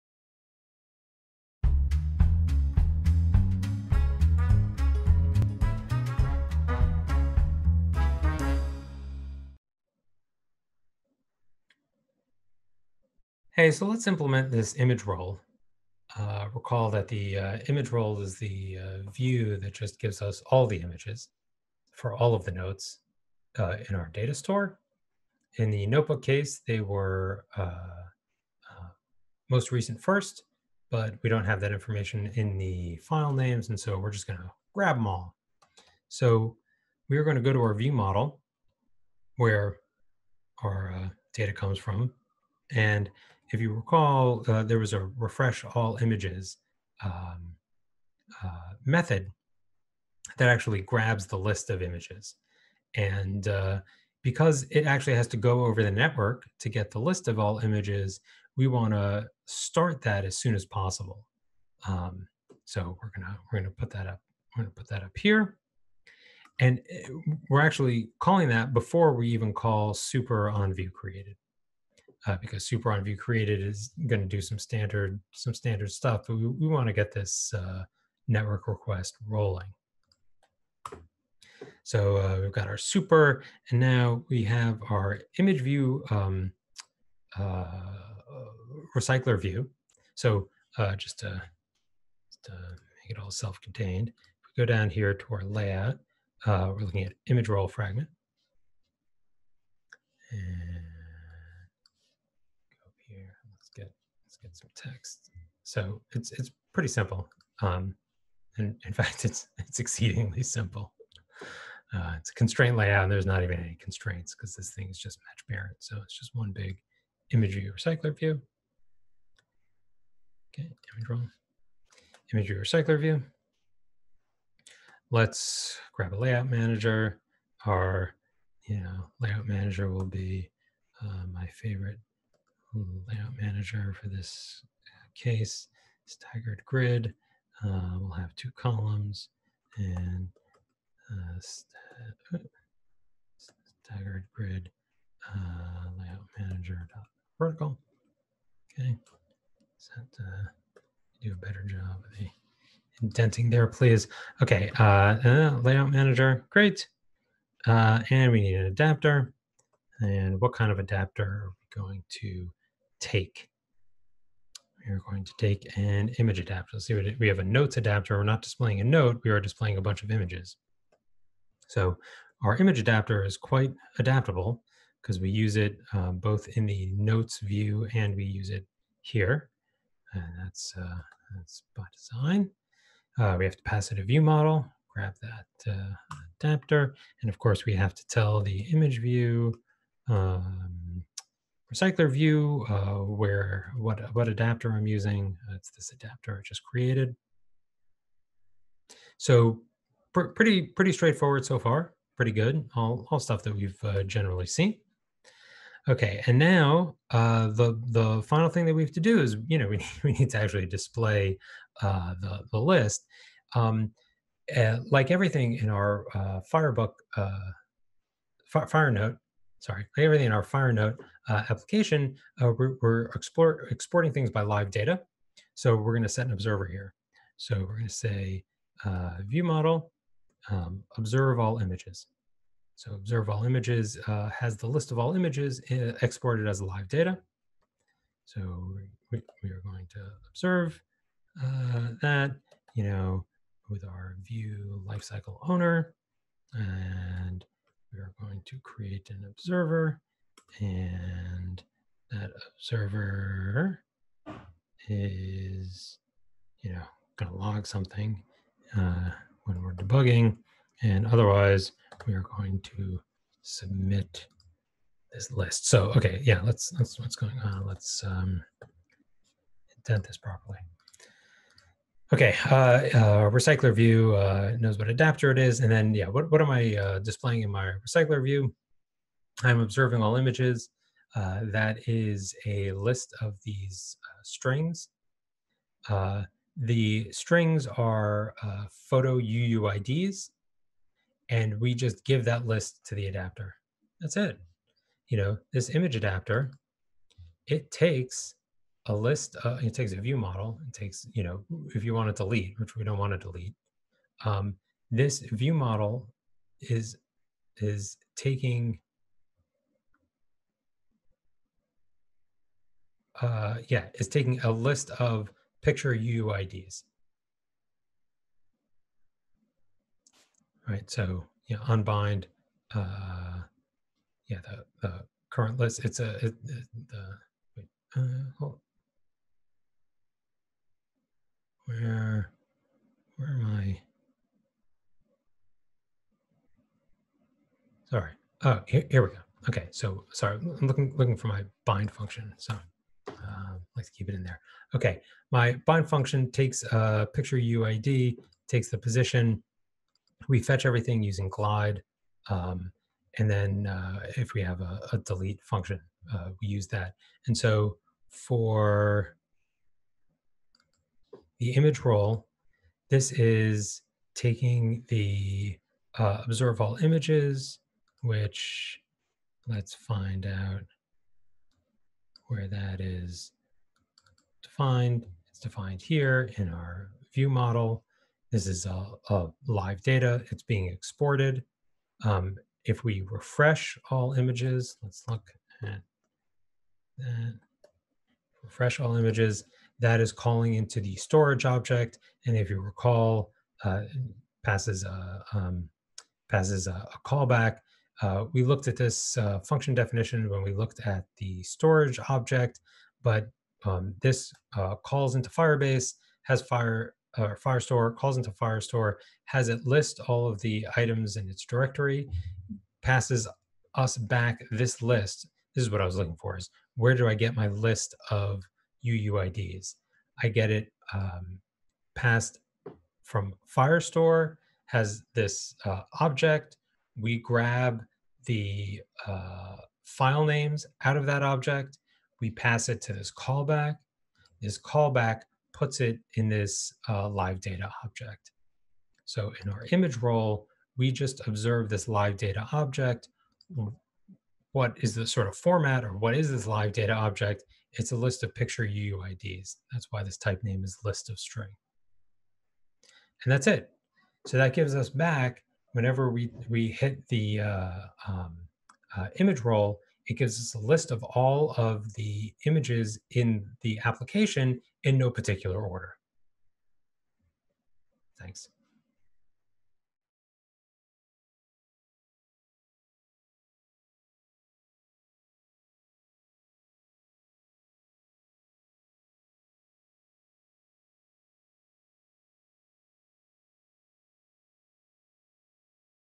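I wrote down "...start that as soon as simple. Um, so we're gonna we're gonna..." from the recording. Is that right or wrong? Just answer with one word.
wrong.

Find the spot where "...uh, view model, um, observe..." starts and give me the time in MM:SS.
03:48.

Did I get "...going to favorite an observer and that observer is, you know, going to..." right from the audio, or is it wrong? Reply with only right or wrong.
wrong.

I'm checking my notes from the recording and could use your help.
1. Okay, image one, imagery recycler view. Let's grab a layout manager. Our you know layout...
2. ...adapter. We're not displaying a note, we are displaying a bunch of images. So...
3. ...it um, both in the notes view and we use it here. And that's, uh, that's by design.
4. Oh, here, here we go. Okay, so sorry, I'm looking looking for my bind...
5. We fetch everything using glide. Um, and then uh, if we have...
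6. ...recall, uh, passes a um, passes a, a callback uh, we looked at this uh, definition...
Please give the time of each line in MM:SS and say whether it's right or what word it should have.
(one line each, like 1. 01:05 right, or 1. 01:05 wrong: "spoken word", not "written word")
1. 02:00 right
2. 02:47 right
3. 02:55 right
4. 05:38 right
5. 05:50 right
6. 06:32 wrong: "function", not "definition".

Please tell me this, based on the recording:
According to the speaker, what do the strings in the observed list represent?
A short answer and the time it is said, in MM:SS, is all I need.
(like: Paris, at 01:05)
Photo UUIDs, at 04:48.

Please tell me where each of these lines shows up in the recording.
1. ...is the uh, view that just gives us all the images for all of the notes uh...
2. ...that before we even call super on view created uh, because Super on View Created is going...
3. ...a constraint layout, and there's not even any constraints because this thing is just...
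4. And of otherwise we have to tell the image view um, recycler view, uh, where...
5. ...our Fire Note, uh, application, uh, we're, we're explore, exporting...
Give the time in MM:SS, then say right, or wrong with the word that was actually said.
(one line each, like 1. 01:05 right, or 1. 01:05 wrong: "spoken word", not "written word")
1. 00:18 right
2. 01:08 right
3. 01:52 right
4. 03:07 wrong: "course", not "otherwise"
5. 03:40 right.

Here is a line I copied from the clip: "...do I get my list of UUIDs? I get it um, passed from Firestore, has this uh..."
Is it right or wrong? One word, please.
right.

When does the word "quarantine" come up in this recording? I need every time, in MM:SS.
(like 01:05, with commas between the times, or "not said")
not said.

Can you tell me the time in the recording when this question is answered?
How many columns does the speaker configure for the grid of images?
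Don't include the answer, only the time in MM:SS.
02:18.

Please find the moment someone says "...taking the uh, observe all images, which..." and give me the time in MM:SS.
06:04.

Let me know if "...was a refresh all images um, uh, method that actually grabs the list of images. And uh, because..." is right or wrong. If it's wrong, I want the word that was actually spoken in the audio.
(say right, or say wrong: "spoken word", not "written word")
right.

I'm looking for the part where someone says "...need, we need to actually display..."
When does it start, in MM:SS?
03:29.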